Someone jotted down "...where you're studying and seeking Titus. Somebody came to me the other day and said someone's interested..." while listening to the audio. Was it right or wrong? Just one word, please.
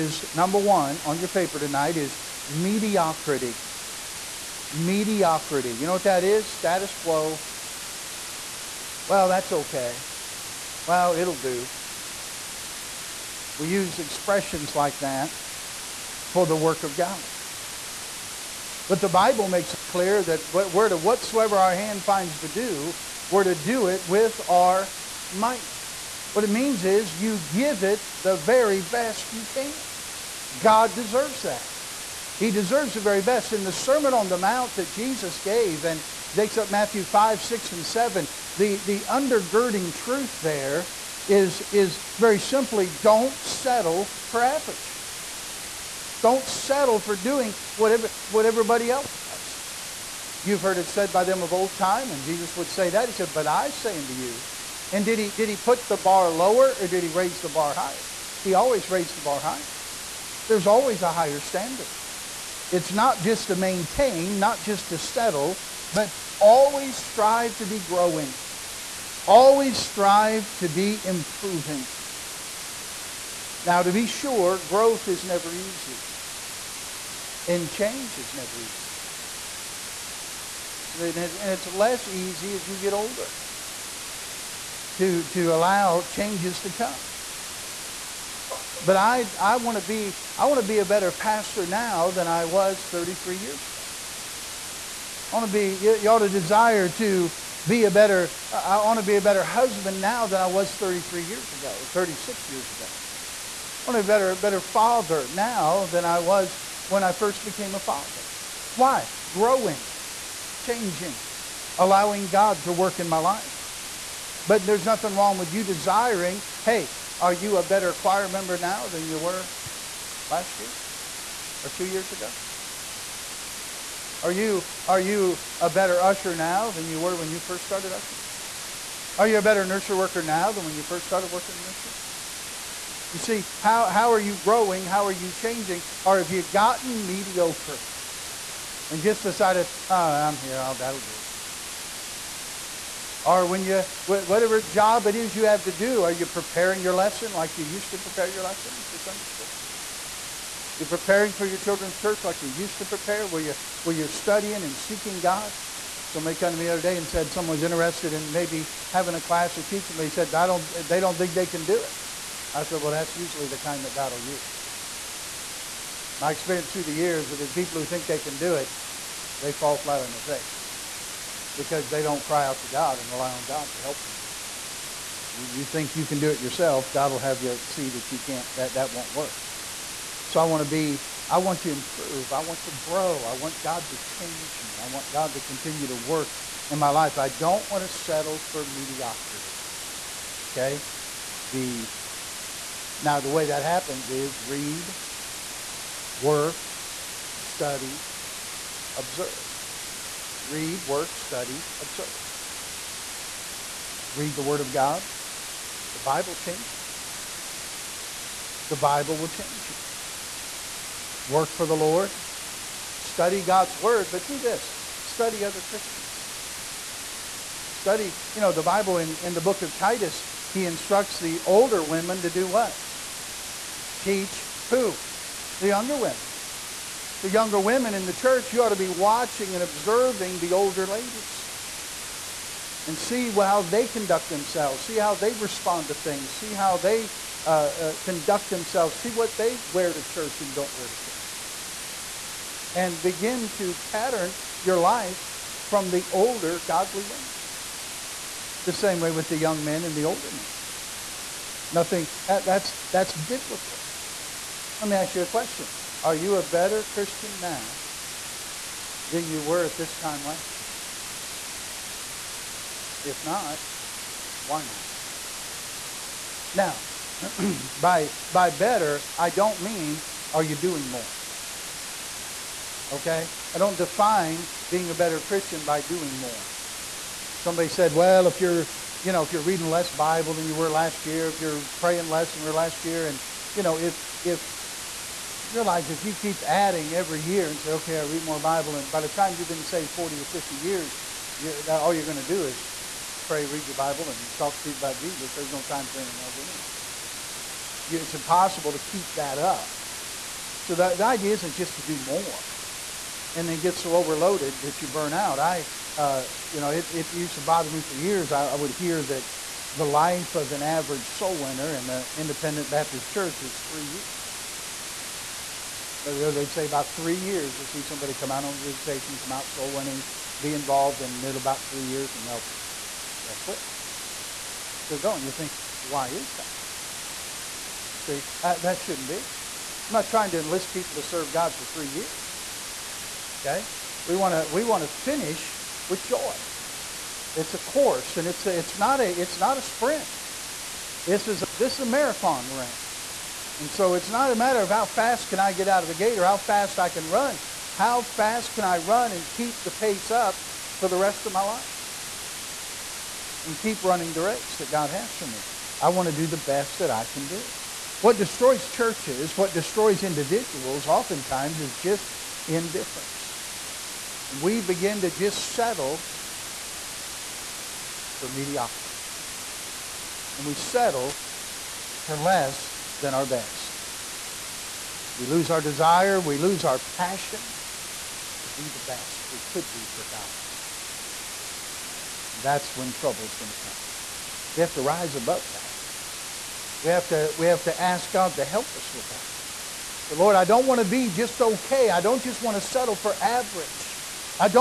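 wrong.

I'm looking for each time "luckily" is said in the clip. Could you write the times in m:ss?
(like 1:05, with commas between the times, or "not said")
not said.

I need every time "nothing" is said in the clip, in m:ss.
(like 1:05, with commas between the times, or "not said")
1:54, 4:11.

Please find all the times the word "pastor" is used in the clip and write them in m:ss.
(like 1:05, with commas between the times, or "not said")
1:31.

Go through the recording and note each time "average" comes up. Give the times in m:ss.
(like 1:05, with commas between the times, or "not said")
0:44, 5:10, 6:33.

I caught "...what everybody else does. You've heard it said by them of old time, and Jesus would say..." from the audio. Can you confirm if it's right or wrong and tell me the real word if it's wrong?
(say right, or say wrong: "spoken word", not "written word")
right.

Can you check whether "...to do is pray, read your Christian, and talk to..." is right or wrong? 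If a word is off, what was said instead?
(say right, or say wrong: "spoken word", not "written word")
wrong: "Bible", not "Christian".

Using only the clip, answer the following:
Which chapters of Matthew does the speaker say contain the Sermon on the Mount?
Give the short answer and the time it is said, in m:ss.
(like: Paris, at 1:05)
5, 6, and 7, at 0:36.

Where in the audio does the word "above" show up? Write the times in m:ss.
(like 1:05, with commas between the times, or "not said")
6:25.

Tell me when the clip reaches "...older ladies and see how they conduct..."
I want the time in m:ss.
3:50.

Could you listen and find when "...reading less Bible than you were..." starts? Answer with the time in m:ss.
4:39.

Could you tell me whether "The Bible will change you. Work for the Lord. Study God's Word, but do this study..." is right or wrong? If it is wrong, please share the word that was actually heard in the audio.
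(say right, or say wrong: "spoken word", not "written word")
right.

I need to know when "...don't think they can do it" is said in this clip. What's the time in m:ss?
2:40.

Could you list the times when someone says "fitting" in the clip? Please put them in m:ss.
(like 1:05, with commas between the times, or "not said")
not said.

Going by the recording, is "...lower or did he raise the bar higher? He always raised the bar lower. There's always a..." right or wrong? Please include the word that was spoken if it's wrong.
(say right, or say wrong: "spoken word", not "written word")
wrong: "higher", not "lower".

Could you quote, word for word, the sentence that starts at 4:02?
And begin to pattern your life from the older godly women.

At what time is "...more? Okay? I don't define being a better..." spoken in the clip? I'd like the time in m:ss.
4:30.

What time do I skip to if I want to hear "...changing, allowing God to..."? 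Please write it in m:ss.
1:50.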